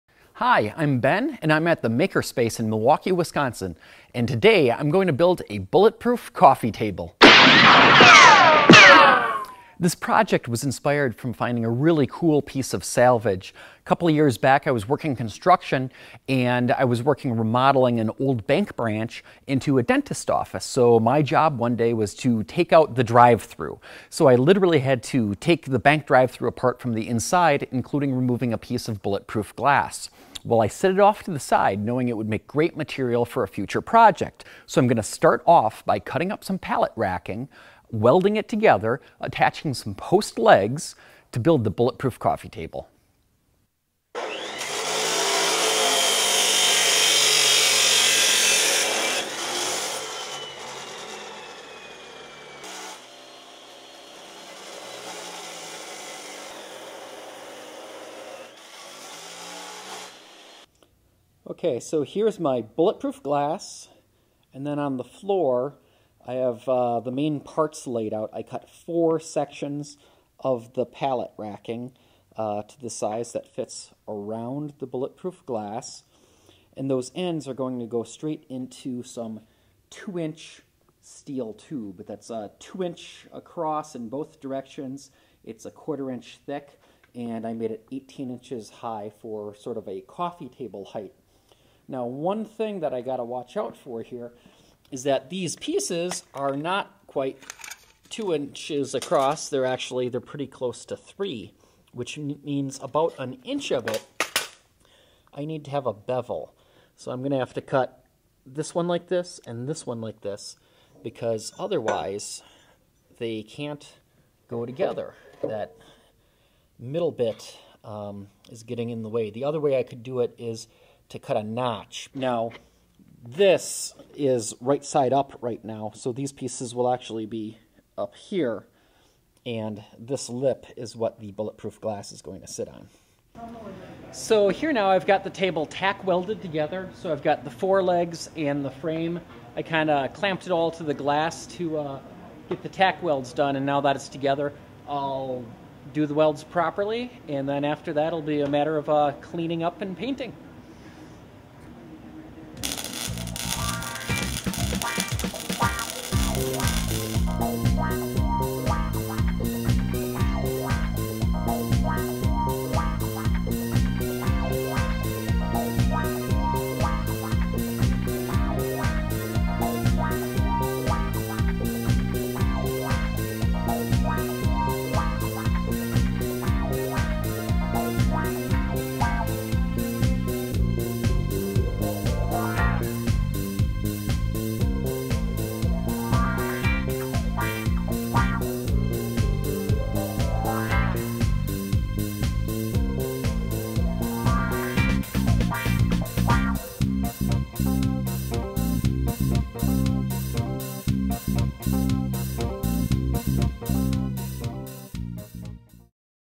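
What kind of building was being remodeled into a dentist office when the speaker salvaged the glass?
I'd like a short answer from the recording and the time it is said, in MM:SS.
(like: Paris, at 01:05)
Old bank branch, at 00:18.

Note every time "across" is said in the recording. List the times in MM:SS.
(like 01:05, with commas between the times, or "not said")
01:23, 01:38.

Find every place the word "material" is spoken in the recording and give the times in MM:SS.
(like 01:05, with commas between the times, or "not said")
00:32.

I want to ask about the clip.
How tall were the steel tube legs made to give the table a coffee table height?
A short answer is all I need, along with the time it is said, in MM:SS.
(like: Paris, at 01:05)
18 inches, at 01:27.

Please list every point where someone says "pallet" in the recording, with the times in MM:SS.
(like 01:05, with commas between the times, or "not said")
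00:36, 01:10.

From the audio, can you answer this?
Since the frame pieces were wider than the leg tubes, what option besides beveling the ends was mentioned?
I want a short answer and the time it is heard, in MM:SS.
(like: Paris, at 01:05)
Cut a notch, at 02:01.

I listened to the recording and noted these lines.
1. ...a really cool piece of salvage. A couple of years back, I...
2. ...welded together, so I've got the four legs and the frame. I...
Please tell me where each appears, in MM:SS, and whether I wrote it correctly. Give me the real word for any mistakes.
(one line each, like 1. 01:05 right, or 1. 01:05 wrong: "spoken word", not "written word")
1. 00:11 right
2. 02:16 right.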